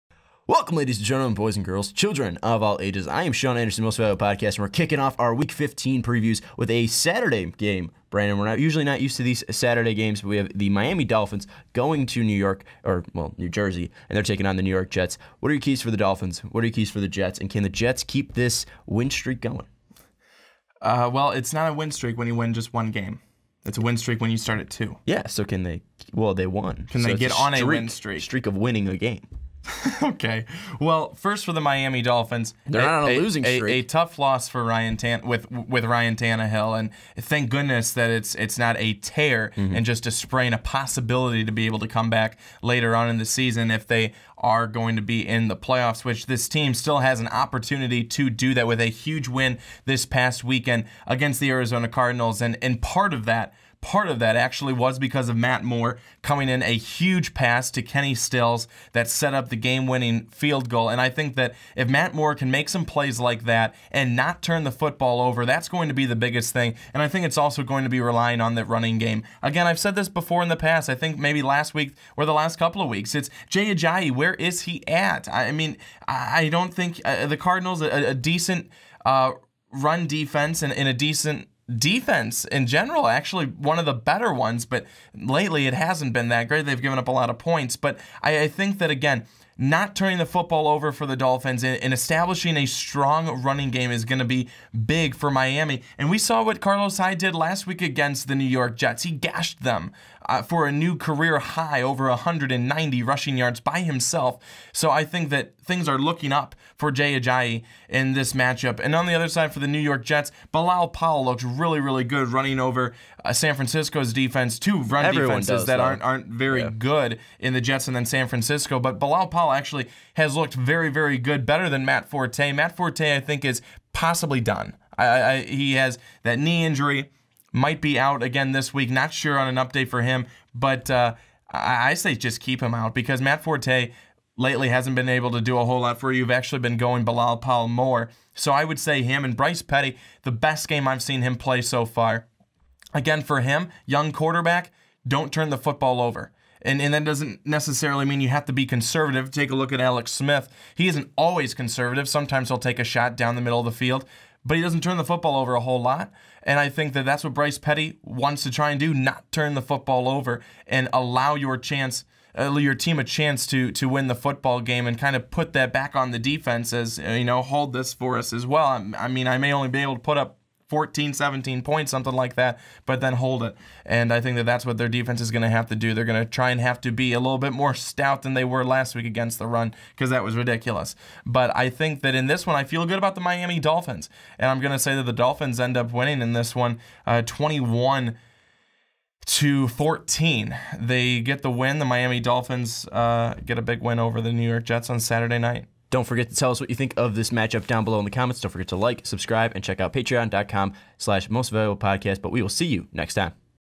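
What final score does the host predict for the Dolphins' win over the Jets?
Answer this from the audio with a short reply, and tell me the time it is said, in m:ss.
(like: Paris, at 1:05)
21-14, at 3:07.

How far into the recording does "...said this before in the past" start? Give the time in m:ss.
1:09.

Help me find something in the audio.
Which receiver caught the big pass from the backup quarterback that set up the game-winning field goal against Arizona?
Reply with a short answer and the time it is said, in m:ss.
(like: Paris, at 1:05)
Kenny Stills, at 0:57.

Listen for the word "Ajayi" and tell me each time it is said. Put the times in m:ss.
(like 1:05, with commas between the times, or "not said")
1:13, 1:47.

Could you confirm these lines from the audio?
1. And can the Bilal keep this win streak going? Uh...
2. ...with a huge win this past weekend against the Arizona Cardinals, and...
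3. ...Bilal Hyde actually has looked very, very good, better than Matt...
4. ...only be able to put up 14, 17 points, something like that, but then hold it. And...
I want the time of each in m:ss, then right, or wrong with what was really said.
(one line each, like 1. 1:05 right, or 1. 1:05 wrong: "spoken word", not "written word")
1. 0:17 wrong: "Jets", not "Bilal"
2. 0:48 right
3. 1:58 wrong: "Powell", not "Hyde"
4. 2:49 right.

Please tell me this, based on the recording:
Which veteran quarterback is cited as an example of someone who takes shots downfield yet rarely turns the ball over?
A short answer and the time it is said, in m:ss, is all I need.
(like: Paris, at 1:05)
Alex Smith, at 2:29.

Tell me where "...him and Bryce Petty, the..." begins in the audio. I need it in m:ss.
2:19.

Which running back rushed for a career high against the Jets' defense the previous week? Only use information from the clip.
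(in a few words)
Carlos Hyde.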